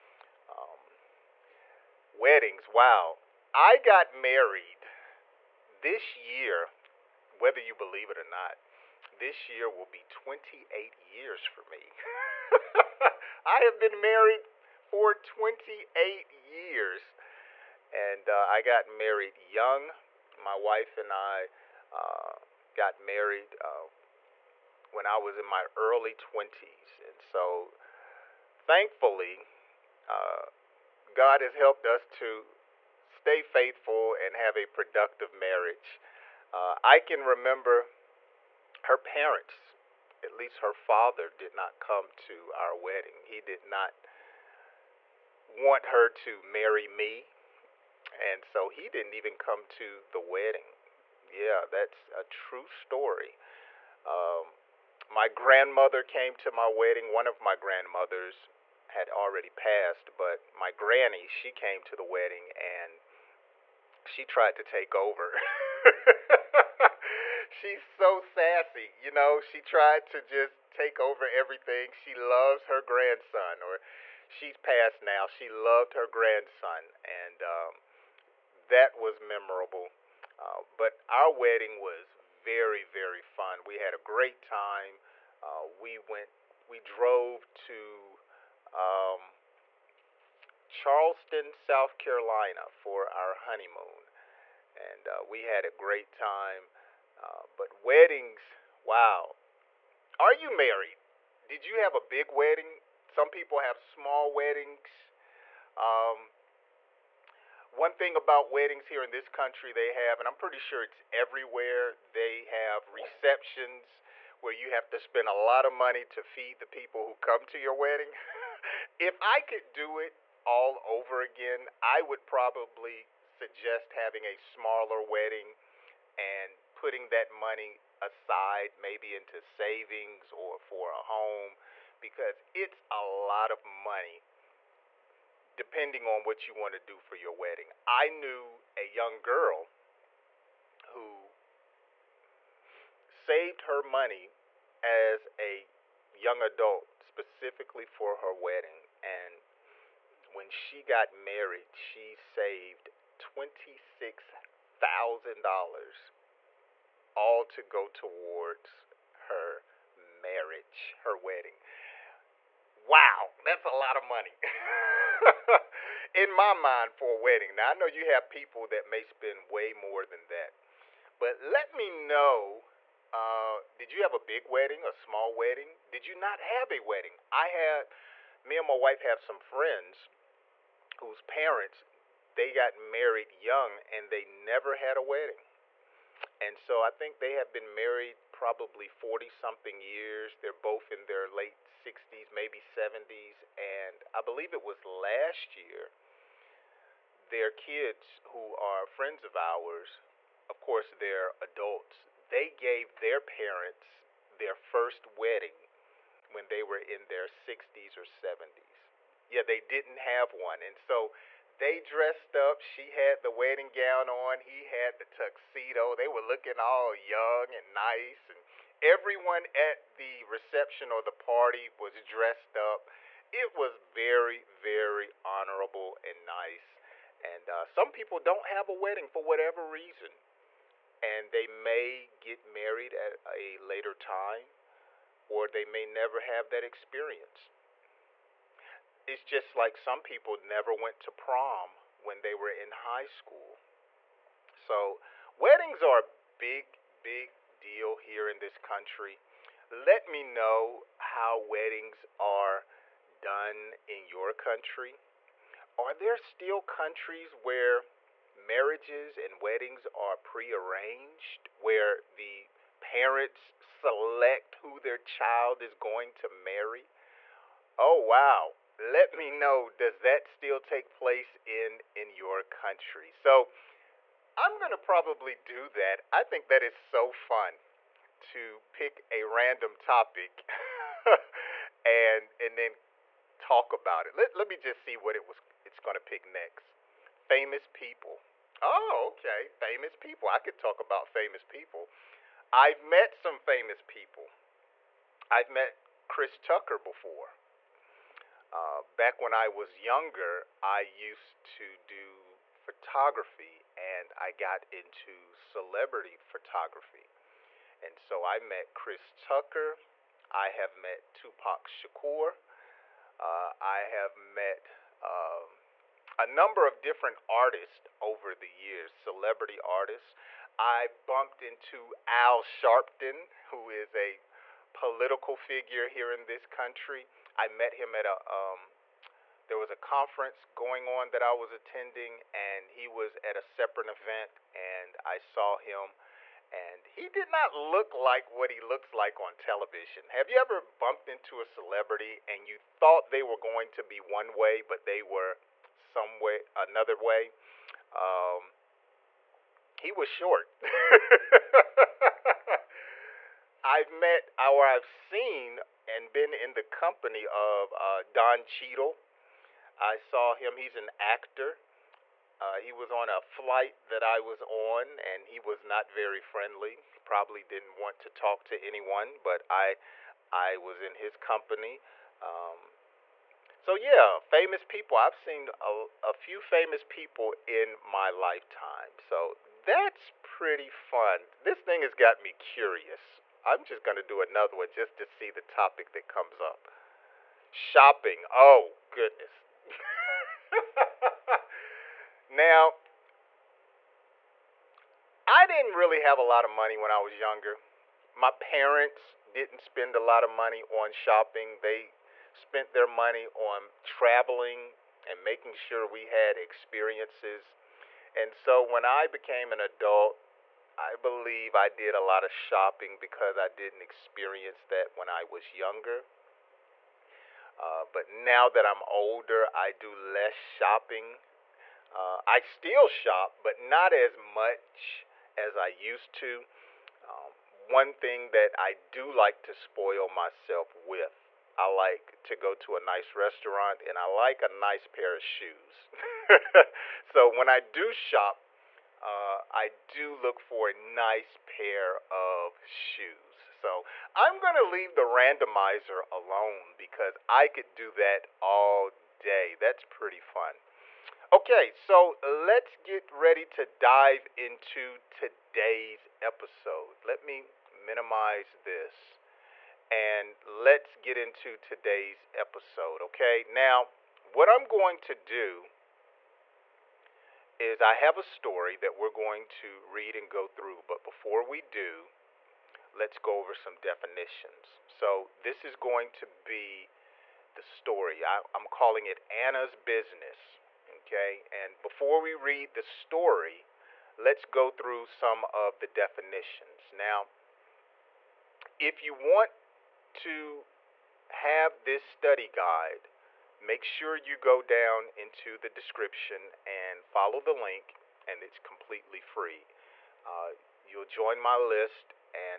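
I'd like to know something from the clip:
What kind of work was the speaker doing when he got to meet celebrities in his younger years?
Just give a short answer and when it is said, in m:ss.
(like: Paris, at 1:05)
celebrity photography, at 5:05.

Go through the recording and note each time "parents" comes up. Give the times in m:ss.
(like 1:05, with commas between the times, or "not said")
0:38, 3:01, 3:23, 4:22, 6:38.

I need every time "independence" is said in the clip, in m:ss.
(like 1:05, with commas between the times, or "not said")
not said.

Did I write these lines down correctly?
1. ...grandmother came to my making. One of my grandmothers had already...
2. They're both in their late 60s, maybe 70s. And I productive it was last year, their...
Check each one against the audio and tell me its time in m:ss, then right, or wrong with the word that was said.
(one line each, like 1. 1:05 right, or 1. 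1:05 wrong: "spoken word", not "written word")
1. 0:55 wrong: "wedding", not "making"
2. 3:10 wrong: "believe", not "productive".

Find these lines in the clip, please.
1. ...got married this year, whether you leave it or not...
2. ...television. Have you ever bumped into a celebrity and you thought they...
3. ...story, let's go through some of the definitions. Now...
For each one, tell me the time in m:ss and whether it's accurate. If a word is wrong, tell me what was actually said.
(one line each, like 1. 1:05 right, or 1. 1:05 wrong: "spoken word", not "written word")
1. 0:03 wrong: "believe", not "leave"
2. 5:39 right
3. 8:02 right.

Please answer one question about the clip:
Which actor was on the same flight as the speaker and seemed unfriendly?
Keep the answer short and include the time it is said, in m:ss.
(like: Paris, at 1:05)
Don Cheadle, at 5:58.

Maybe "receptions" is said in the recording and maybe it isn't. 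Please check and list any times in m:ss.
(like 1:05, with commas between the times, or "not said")
1:52, 3:40.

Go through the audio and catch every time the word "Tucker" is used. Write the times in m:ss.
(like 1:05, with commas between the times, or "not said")
4:56, 5:09.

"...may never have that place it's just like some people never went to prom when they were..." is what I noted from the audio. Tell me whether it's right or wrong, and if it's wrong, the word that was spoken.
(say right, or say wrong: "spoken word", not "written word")
wrong: "experience", not "place".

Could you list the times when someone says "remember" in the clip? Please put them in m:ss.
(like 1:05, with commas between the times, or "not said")
0:37.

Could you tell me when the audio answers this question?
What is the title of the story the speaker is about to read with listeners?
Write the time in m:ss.
7:59.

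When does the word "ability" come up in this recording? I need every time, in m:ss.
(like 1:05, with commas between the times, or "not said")
not said.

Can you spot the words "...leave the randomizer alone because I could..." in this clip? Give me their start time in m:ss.
7:24.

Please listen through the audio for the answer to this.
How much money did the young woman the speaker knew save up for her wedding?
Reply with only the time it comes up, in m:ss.
2:33.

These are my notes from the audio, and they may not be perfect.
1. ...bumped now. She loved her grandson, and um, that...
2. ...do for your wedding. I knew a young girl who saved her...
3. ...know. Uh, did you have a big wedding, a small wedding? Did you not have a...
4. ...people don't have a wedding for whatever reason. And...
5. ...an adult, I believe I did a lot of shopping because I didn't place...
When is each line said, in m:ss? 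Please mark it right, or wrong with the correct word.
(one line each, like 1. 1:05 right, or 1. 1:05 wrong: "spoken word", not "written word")
1. 1:14 wrong: "passed", not "bumped"
2. 2:16 right
3. 2:51 right
4. 3:47 right
5. 6:49 wrong: "experience", not "place".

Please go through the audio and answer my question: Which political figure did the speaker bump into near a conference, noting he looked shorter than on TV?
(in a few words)
Al Sharpton.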